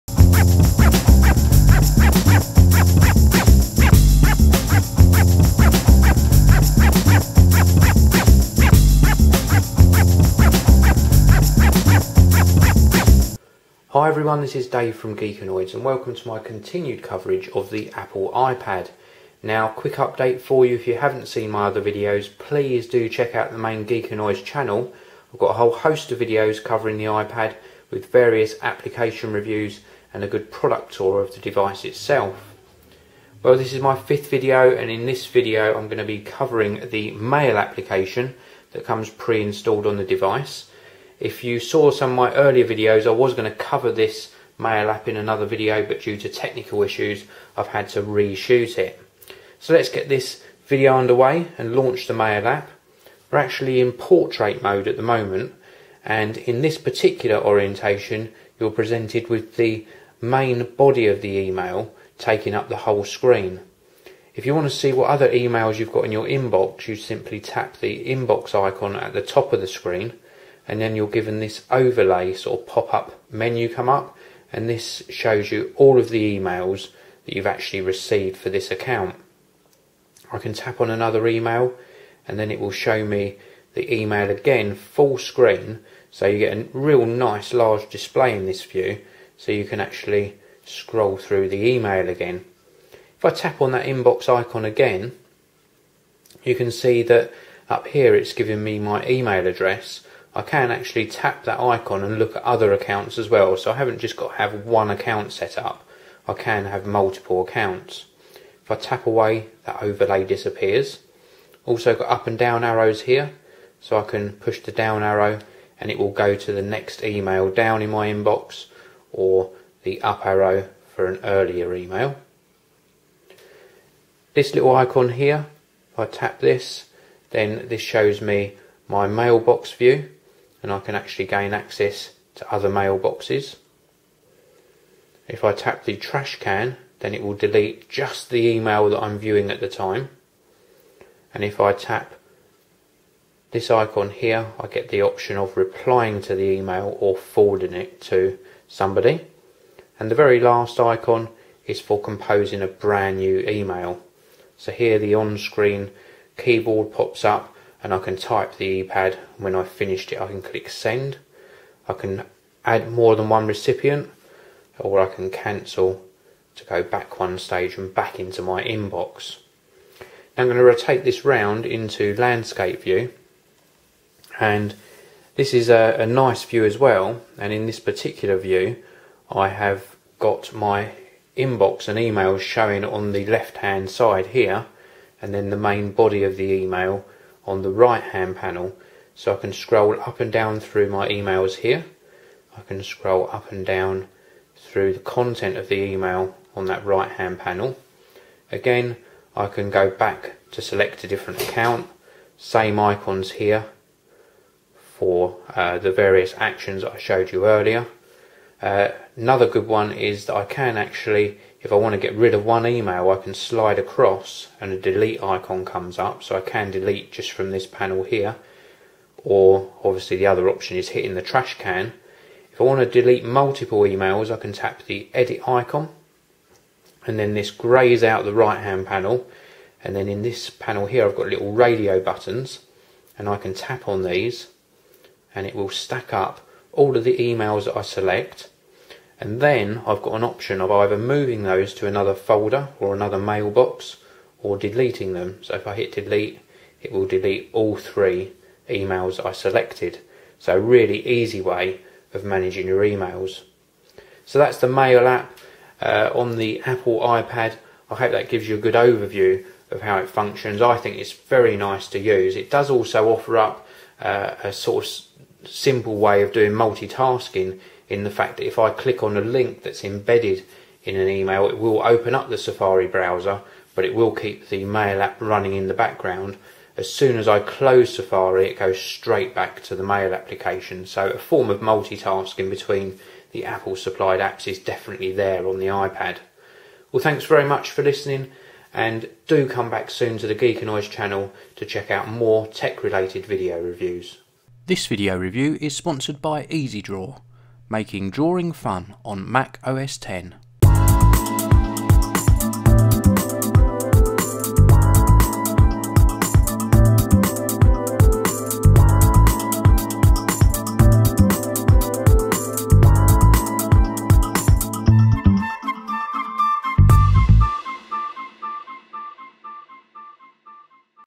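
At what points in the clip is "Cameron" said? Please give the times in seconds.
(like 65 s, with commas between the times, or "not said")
not said.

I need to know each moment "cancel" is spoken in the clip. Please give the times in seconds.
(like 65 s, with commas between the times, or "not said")
165 s.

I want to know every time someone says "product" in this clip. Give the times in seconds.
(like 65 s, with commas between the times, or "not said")
30 s.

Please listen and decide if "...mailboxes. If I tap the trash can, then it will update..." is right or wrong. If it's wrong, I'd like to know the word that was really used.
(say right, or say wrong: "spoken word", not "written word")
wrong: "delete", not "update".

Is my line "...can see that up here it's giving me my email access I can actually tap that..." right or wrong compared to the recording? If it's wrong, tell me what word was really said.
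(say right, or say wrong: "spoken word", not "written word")
wrong: "address", not "access".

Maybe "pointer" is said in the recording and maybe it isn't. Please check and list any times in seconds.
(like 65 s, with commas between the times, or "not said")
not said.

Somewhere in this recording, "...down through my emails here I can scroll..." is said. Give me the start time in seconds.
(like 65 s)
190 s.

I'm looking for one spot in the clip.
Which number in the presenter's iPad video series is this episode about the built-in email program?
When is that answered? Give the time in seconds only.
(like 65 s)
33 s.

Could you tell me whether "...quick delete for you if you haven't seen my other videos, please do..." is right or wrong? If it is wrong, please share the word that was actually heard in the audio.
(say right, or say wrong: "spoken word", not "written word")
wrong: "update", not "delete".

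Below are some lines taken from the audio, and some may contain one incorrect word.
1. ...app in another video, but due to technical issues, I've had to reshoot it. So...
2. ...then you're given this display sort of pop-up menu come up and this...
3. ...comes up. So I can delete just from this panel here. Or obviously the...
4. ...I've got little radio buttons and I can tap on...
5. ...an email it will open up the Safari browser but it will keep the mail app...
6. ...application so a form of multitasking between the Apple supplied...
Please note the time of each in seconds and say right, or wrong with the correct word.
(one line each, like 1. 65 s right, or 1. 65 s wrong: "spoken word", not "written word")
1. 44 s right
2. 70 s wrong: "overlay", not "display"
3. 215 s right
4. 231 s right
5. 270 s right
6. 280 s right.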